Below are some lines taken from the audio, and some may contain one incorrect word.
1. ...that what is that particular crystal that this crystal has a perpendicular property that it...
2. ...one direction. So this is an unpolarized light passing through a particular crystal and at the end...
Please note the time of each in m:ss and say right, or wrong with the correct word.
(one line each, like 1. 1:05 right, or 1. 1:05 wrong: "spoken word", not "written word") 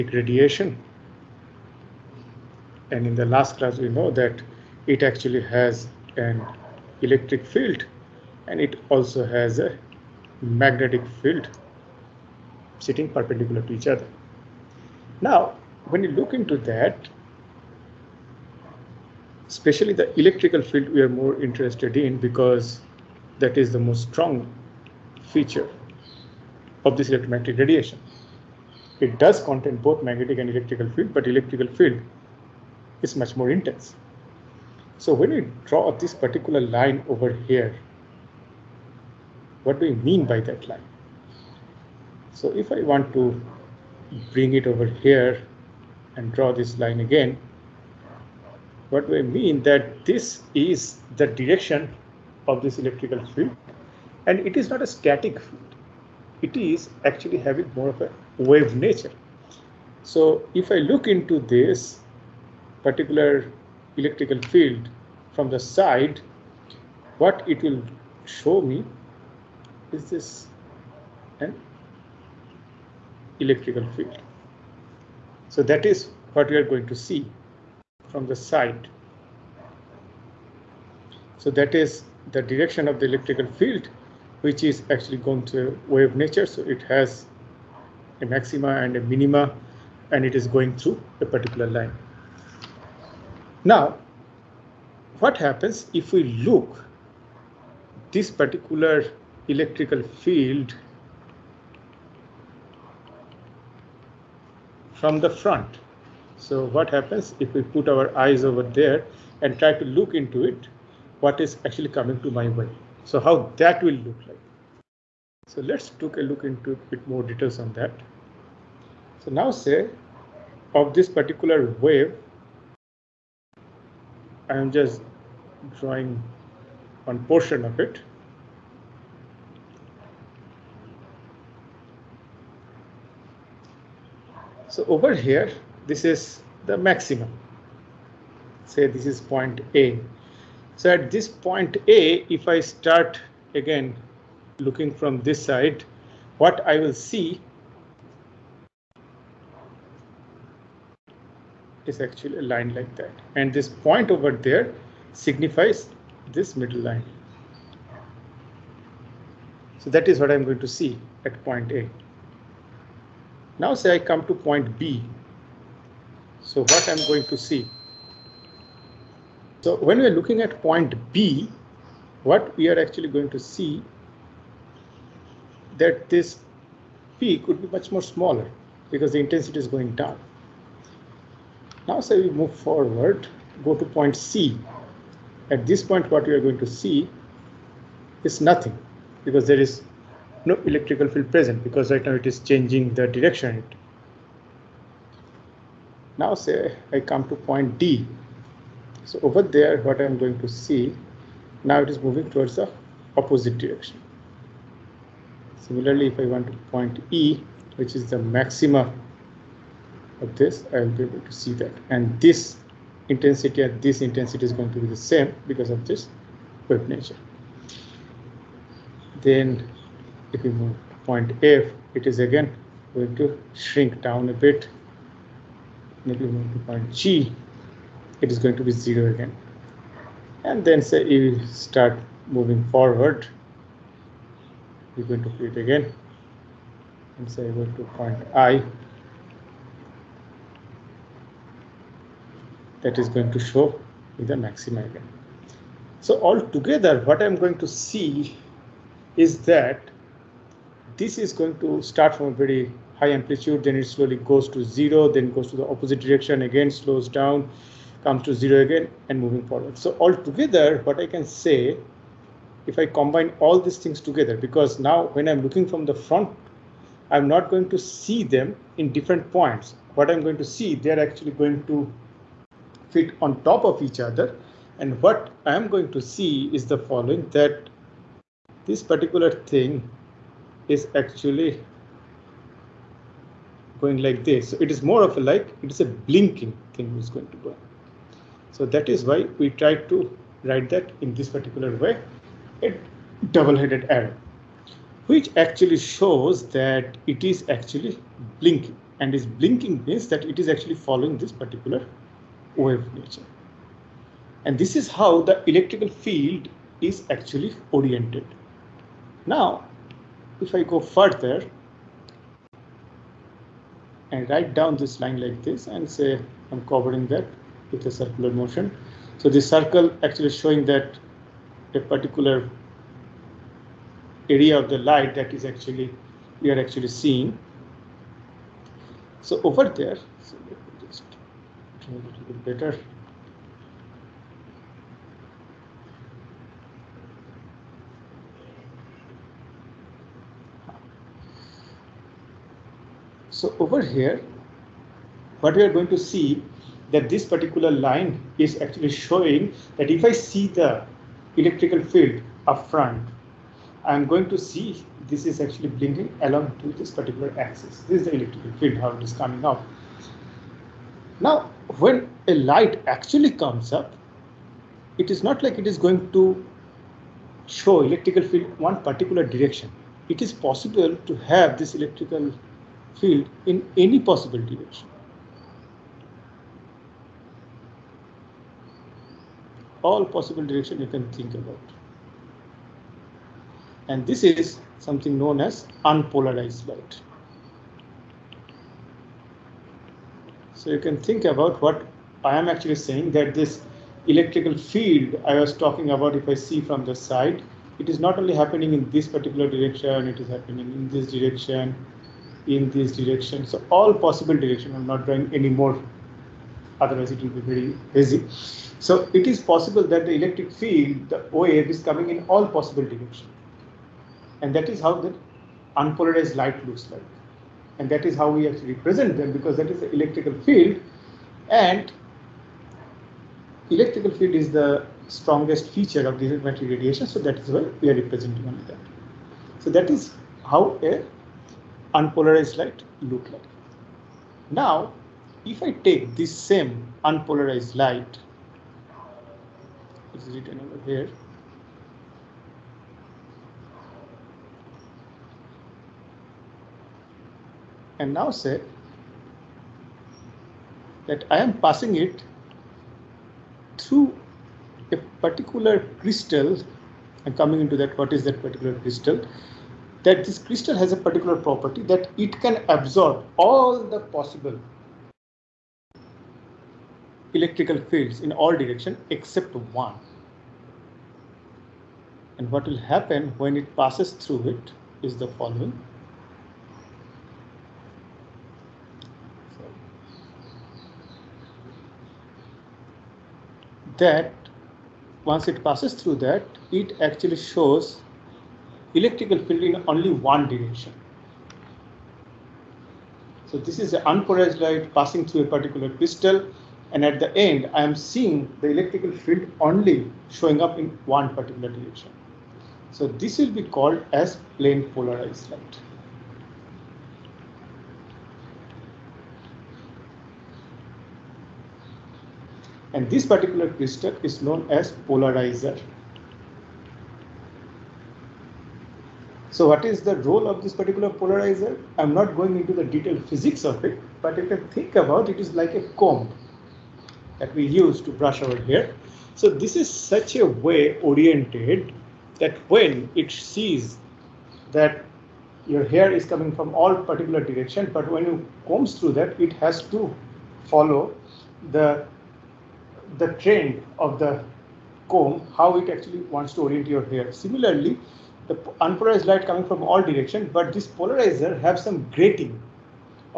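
1. 7:37 wrong: "particular", not "perpendicular"
2. 8:10 right.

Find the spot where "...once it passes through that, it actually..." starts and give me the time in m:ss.
8:05.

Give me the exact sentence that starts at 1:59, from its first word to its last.
So now say of this particular wave, I am just drawing one portion of it.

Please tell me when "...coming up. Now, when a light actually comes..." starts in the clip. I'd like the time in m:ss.
5:59.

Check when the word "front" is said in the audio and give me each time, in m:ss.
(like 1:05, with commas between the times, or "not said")
1:45, 4:25, 5:52.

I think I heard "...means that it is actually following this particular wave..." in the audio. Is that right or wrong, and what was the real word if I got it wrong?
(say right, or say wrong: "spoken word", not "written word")
right.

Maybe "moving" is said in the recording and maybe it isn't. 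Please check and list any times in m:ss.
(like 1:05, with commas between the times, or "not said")
3:21, 3:52, 4:19.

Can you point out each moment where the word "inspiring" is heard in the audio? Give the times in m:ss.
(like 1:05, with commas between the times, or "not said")
not said.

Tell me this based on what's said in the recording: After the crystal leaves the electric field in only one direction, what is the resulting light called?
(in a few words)
Plane polarized light.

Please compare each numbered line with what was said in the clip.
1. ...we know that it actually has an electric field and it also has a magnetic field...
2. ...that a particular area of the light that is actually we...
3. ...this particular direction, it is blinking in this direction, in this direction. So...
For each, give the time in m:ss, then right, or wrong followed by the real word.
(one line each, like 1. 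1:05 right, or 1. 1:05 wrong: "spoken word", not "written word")
1. 0:03 right
2. 5:20 right
3. 6:38 wrong: "happening", not "blinking".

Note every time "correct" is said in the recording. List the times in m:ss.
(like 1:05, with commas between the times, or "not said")
not said.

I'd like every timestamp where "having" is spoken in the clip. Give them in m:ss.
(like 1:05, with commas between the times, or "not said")
0:57.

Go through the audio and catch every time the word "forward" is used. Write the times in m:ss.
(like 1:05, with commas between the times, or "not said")
3:02, 3:52, 4:19.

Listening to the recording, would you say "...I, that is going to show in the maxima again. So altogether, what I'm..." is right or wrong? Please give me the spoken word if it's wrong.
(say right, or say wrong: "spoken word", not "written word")
right.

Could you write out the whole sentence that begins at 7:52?
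And what will happen when it passes through it is the following.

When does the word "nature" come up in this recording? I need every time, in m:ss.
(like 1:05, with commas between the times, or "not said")
0:58, 1:26, 3:36, 5:02.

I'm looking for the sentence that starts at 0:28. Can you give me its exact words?
It does contain both magnetic and electrical field, but electrical field is much more intense.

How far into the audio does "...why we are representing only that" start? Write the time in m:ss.
7:07.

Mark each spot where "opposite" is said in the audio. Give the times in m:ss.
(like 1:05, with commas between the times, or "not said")
3:23, 4:15.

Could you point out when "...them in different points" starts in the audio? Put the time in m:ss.
4:28.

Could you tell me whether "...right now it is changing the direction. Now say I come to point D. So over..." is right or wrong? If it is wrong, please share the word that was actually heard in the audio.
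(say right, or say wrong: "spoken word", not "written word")
right.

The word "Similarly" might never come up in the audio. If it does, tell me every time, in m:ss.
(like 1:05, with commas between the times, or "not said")
3:25, 9:07.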